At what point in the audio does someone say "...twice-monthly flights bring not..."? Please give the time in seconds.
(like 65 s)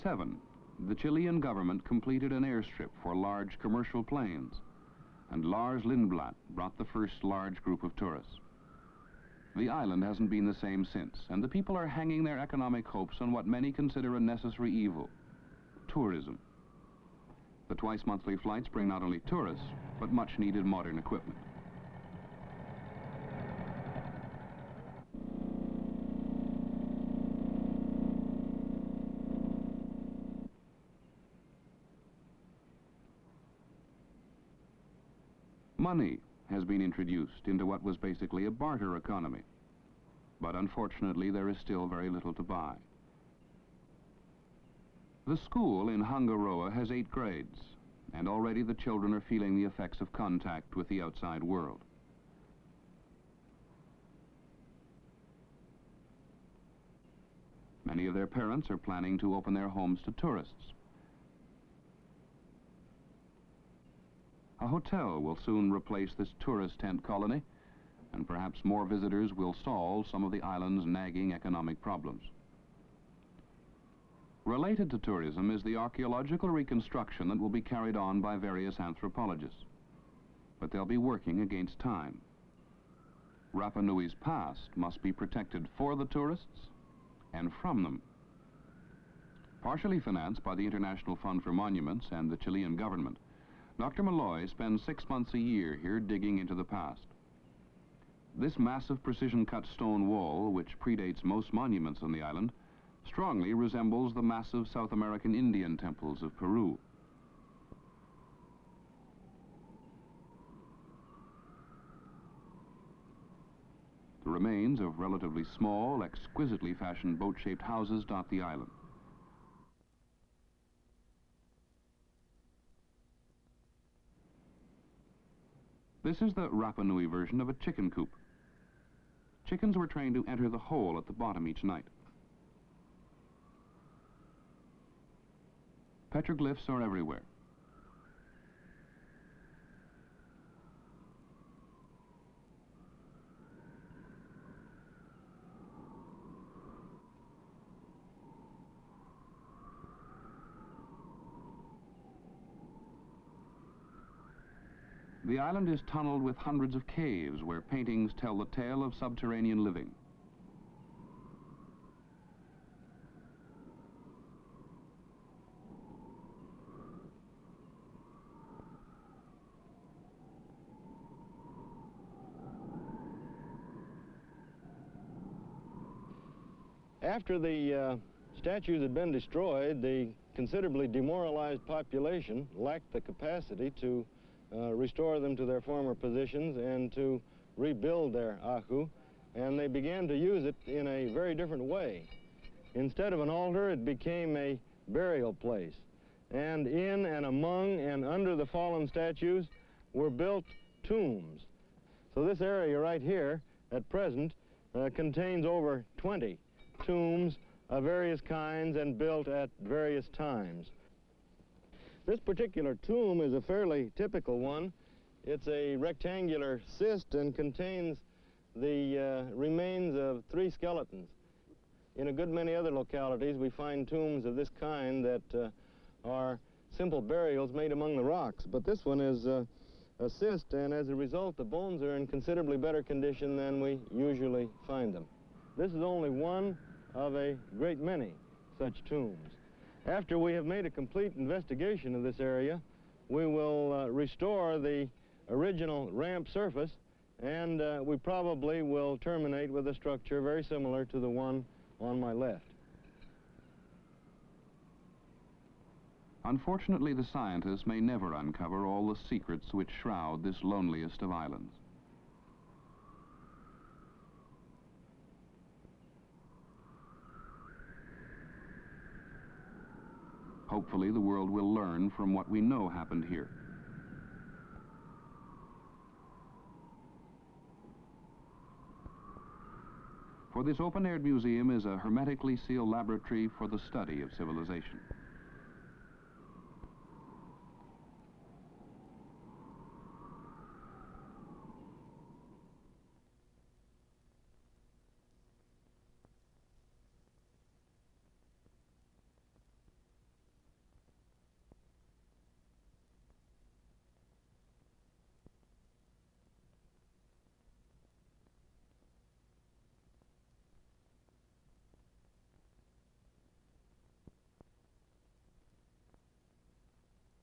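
17 s.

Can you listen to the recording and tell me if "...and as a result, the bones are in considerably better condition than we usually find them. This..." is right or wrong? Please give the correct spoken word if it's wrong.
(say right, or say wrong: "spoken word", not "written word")
right.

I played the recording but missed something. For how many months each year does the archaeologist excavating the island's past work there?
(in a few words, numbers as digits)
6.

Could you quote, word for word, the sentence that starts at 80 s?
But they'll be working against time.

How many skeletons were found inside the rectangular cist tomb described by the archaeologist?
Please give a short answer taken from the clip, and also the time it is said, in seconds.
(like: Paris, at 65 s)
3, at 220 s.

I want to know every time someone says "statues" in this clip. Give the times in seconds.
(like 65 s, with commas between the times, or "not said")
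178 s, 198 s.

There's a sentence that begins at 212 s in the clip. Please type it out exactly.
This particular tomb is a fairly typical one.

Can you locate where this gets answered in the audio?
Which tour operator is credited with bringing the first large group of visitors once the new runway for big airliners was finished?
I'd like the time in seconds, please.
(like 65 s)
5 s.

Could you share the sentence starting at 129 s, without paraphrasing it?
Chickens were trained to enter the hole at the bottom each night.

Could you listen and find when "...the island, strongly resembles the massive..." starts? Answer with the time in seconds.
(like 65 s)
102 s.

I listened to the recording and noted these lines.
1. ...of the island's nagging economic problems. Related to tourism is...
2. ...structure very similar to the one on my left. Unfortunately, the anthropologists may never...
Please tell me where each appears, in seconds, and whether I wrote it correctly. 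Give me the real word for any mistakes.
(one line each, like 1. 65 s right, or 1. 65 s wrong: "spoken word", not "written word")
1. 70 s right
2. 249 s wrong: "scientists", not "anthropologists".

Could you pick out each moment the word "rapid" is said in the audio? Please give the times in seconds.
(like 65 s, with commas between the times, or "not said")
not said.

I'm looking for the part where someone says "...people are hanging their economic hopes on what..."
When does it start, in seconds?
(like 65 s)
11 s.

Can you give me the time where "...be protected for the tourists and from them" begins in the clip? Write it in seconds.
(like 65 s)
85 s.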